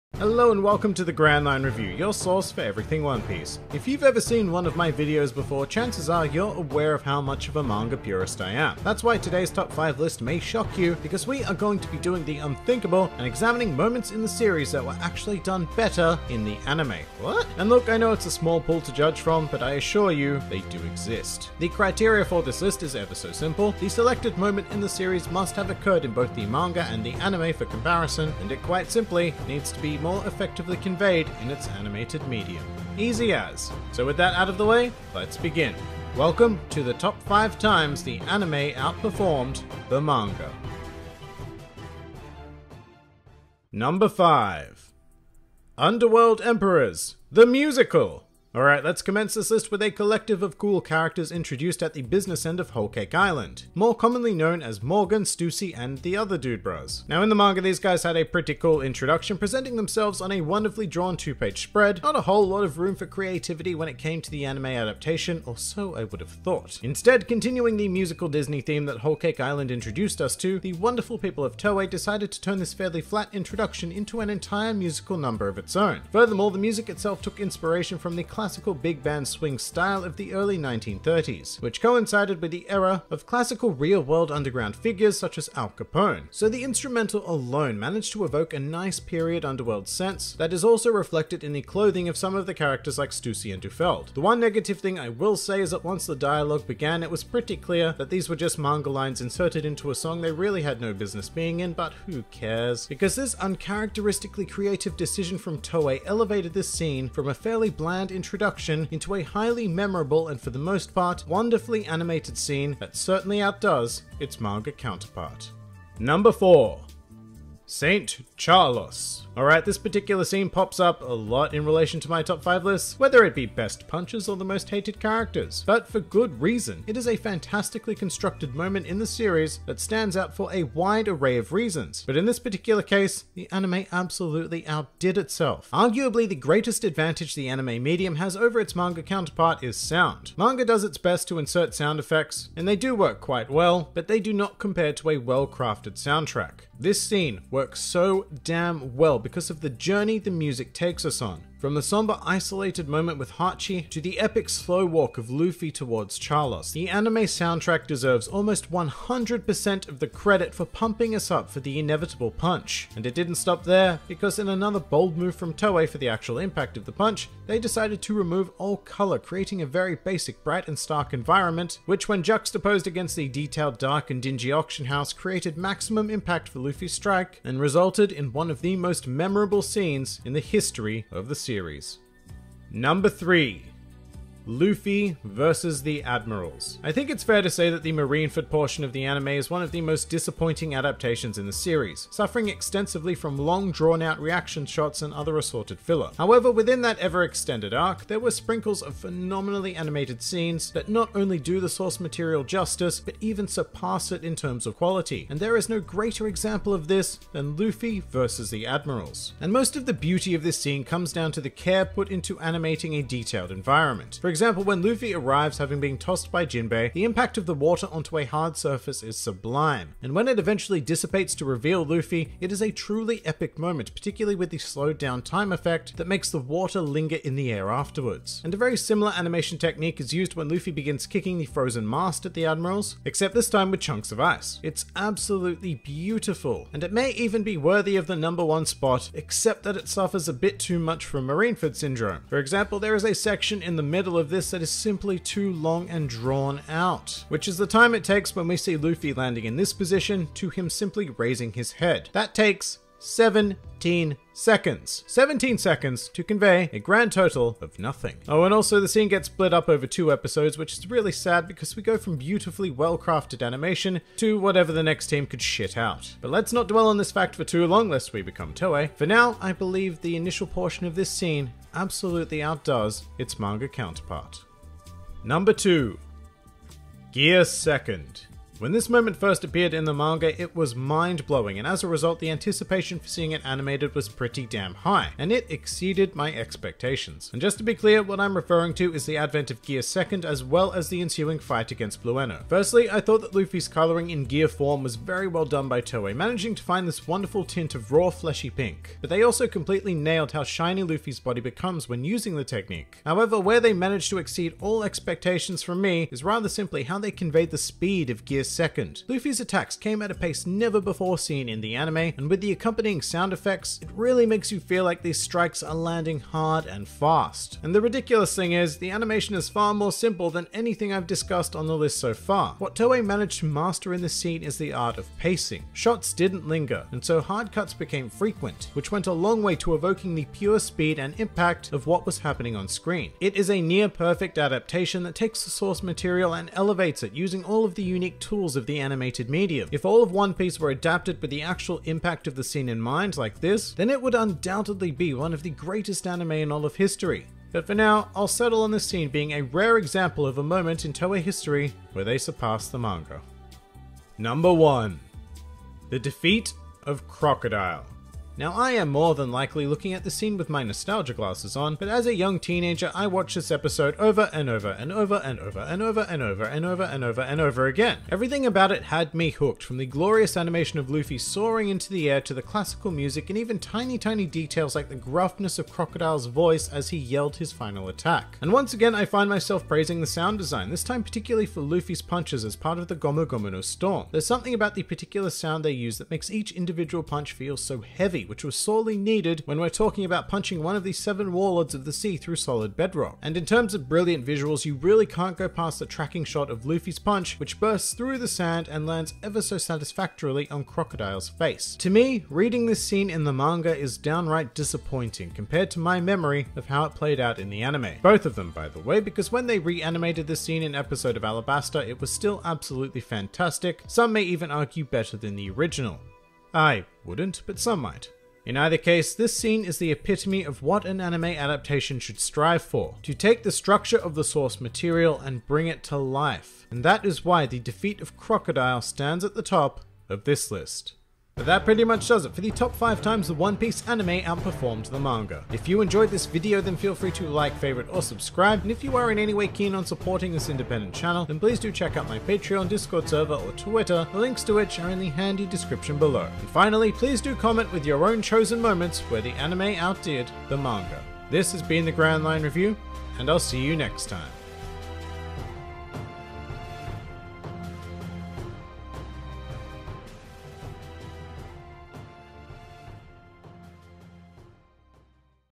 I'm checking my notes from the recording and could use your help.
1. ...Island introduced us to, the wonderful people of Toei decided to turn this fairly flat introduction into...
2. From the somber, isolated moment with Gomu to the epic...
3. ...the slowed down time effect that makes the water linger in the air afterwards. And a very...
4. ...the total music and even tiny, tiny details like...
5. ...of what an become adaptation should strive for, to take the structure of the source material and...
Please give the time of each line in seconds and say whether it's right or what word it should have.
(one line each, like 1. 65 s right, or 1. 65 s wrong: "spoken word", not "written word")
1. 69 s right
2. 151 s wrong: "Hachi", not "Gomu"
3. 224 s right
4. 372 s wrong: "classical", not "total"
5. 420 s wrong: "anime", not "become".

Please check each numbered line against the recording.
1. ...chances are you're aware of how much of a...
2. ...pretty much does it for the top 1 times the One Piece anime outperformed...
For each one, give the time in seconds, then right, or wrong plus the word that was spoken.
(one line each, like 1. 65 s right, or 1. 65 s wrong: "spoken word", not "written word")
1. 5 s right
2. 431 s wrong: "5", not "1".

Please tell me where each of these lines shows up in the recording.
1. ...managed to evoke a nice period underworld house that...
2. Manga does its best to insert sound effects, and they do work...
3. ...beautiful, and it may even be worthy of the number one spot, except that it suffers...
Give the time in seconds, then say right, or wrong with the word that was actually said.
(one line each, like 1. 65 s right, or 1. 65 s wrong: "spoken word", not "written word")
1. 87 s wrong: "sense", not "house"
2. 140 s right
3. 235 s right.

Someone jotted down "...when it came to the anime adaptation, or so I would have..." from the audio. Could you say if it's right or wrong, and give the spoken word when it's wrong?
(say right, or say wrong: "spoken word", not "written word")
right.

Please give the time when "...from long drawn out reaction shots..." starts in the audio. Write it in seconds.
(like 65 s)
193 s.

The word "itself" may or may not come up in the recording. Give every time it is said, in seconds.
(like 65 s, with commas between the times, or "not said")
76 s, 135 s.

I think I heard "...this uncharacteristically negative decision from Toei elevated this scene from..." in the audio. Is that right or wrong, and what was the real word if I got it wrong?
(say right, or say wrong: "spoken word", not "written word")
wrong: "creative", not "negative".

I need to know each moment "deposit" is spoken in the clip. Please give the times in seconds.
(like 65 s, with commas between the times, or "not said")
not said.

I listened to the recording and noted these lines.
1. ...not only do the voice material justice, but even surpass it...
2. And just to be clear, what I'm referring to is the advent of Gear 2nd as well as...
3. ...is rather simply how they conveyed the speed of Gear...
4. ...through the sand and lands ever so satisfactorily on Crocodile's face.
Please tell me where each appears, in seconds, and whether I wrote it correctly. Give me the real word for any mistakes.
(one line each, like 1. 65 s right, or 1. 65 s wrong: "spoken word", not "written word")
1. 200 s wrong: "source", not "voice"
2. 287 s right
3. 306 s right
4. 397 s right.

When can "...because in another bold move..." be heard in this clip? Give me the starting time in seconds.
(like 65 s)
164 s.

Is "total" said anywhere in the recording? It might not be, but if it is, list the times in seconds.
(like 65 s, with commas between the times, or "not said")
257 s.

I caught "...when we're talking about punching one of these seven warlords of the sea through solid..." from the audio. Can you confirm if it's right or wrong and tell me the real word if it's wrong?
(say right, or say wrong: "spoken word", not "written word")
right.